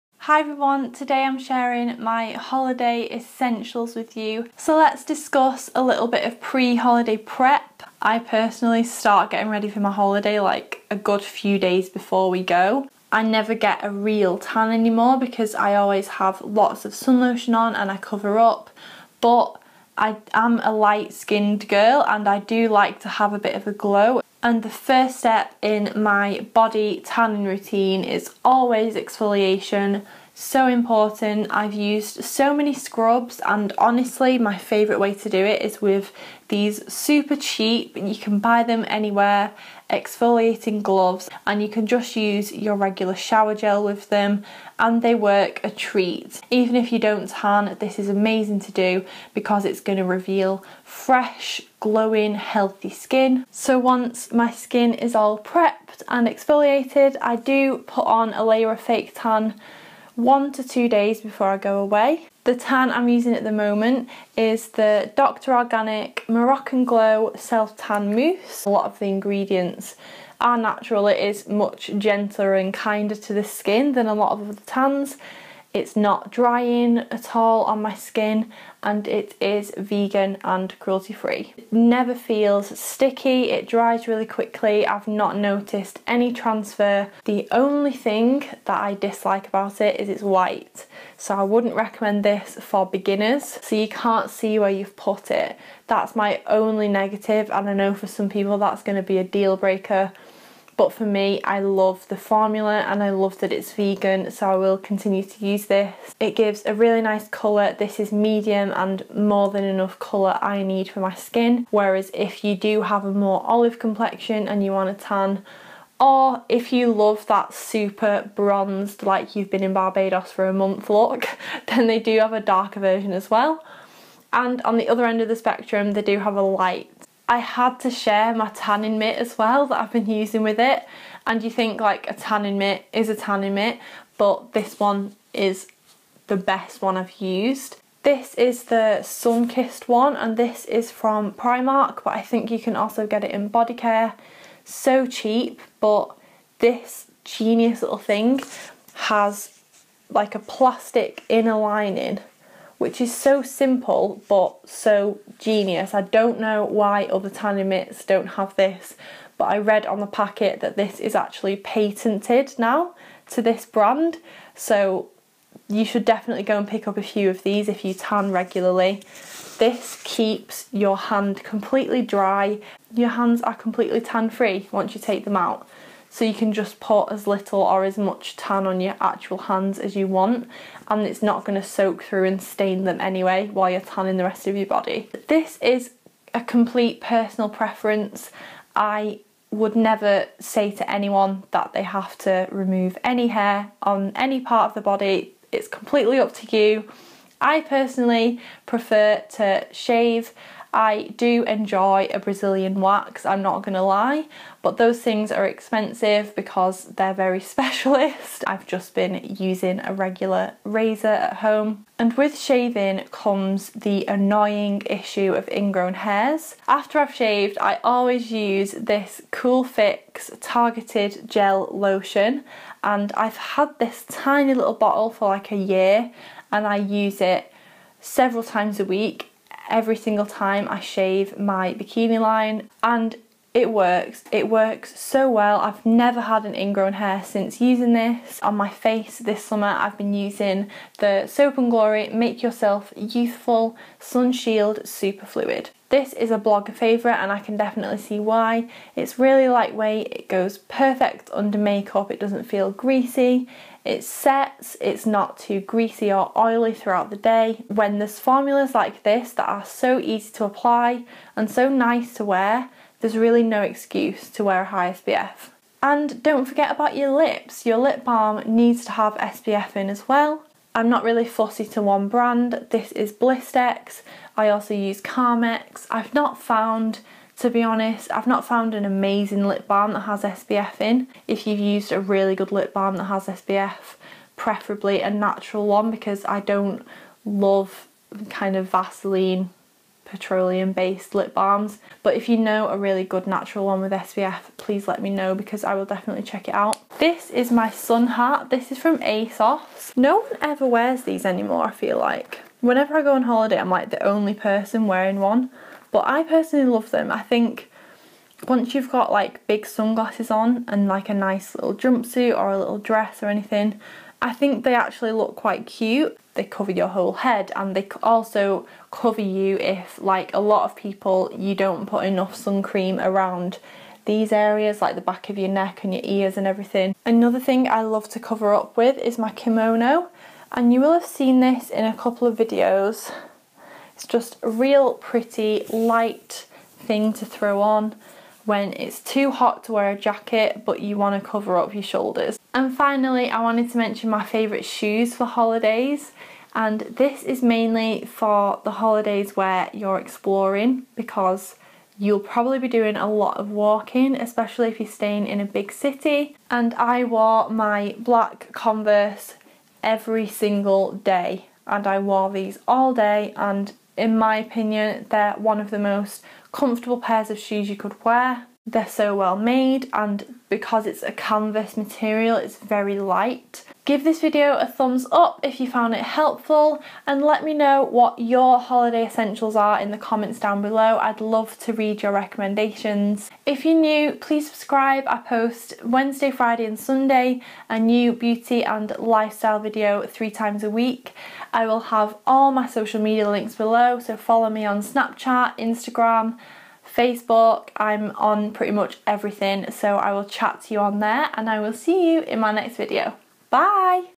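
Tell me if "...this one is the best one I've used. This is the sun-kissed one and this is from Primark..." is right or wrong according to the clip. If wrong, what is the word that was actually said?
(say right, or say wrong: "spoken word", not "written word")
right.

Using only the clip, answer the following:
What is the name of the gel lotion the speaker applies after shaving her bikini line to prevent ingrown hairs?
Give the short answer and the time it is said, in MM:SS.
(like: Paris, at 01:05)
Cool Fix, at 03:39.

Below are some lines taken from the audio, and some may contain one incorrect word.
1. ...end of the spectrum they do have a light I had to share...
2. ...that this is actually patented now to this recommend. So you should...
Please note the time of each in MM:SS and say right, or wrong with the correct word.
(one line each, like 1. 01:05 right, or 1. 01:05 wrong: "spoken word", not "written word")
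1. 02:05 right
2. 02:40 wrong: "brand", not "recommend".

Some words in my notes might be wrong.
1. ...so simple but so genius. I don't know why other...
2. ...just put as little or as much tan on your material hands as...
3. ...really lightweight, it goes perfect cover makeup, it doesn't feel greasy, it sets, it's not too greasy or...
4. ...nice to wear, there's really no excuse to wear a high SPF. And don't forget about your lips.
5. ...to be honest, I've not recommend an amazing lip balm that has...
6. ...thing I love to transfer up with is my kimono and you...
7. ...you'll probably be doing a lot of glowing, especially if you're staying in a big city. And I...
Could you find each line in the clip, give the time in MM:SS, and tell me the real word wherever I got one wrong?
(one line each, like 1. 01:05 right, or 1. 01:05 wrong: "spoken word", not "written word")
1. 02:33 right
2. 02:56 wrong: "actual", not "material"
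3. 04:09 wrong: "under", not "cover"
4. 04:21 right
5. 04:37 wrong: "found", not "recommend"
6. 05:27 wrong: "cover", not "transfer"
7. 05:51 wrong: "walking", not "glowing".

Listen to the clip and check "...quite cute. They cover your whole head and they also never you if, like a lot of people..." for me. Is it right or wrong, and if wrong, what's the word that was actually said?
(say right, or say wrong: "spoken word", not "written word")
wrong: "cover", not "never".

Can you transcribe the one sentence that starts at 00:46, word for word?
Even if you don't tan, this is amazing to do because it's going to reveal fresh, glowing, healthy skin.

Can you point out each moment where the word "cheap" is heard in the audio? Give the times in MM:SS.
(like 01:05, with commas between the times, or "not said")
00:37, 02:25.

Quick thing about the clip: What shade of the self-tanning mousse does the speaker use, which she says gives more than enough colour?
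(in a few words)
Medium.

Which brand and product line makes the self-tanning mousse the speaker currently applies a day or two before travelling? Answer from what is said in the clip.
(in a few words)
Dr. Organic Moroccan Glow.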